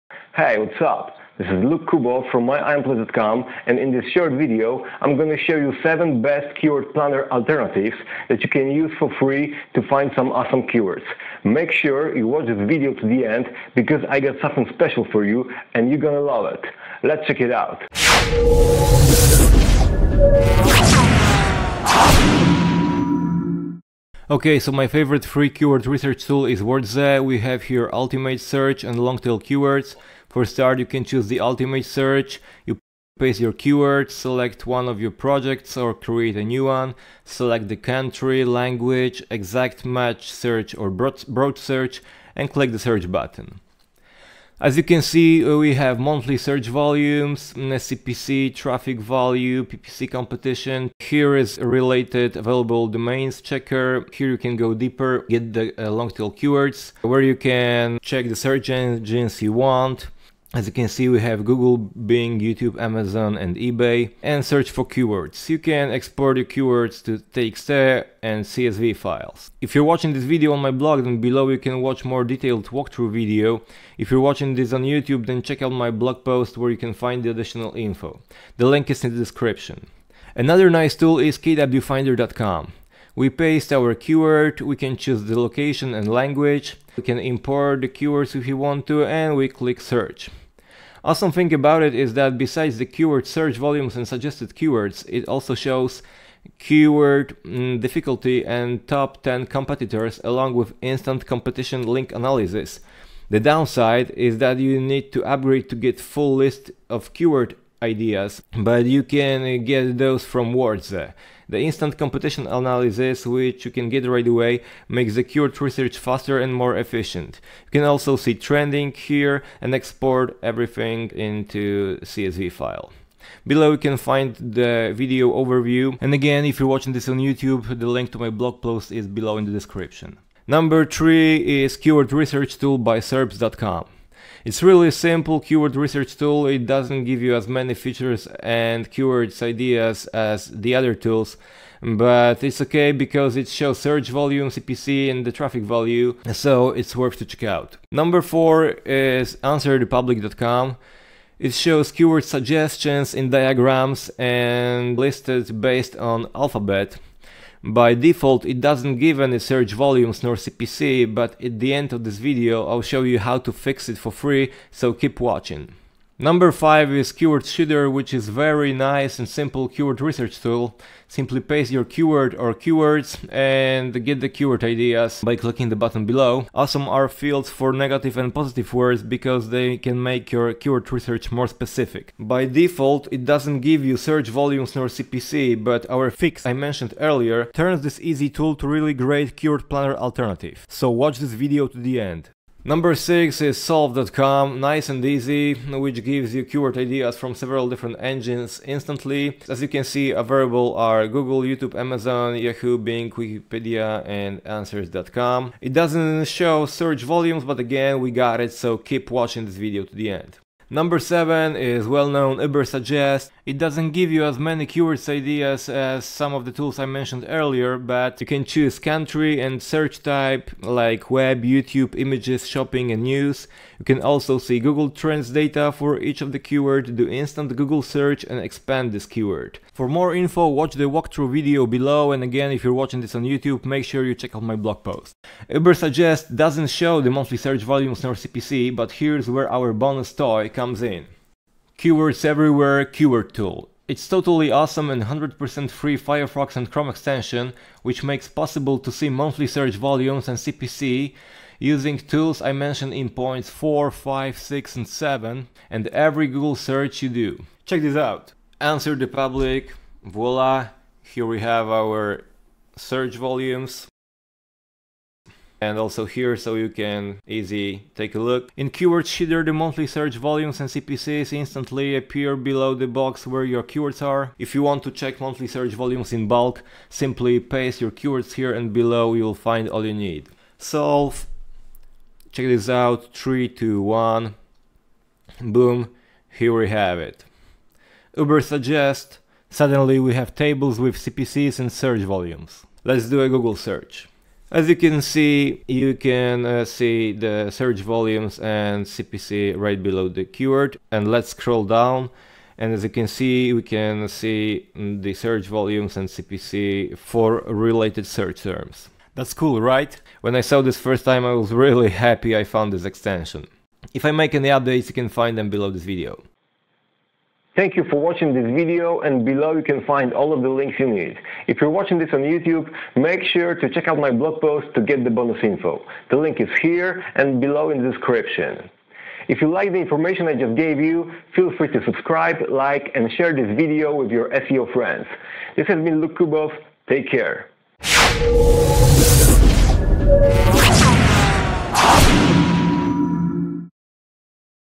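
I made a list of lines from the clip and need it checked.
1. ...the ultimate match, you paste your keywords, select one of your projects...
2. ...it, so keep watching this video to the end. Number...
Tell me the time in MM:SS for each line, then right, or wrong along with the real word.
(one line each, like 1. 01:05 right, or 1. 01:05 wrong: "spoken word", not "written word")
1. 00:31 wrong: "search", not "match"
2. 03:28 right.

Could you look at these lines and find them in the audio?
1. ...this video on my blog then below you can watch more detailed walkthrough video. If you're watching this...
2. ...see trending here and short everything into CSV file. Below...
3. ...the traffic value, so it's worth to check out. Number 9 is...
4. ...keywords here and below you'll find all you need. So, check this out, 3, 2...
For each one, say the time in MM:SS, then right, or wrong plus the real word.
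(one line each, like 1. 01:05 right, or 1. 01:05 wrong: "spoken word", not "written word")
1. 01:10 right
2. 01:58 wrong: "export", not "short"
3. 02:25 wrong: "4", not "9"
4. 04:37 right.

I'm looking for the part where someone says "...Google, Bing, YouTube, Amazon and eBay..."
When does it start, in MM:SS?
01:01.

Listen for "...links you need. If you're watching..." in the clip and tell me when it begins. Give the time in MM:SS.
05:20.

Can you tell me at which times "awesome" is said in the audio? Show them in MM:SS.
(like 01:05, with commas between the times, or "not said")
00:10, 01:31, 02:56, 04:04.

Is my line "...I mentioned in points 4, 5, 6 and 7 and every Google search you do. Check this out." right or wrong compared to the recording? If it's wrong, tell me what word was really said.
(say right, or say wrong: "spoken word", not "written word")
right.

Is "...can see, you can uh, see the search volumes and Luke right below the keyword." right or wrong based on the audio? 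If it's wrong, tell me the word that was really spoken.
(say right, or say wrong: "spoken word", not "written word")
wrong: "CPC", not "Luke".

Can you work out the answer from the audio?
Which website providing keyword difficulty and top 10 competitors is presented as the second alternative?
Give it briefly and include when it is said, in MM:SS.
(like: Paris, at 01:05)
kwfinder.com, at 01:21.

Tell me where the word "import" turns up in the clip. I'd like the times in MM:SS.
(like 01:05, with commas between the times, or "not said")
01:27.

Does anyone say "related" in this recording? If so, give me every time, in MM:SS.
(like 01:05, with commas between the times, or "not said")
00:51, 05:07.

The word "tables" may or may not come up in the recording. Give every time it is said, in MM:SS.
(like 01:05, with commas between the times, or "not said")
04:50.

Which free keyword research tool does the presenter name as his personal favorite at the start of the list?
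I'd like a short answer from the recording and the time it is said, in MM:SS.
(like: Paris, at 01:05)
WordZe, at 00:26.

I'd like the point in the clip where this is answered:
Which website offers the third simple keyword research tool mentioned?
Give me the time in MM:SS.
02:12.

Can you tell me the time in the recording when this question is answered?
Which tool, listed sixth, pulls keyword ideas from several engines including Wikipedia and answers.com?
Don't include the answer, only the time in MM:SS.
03:13.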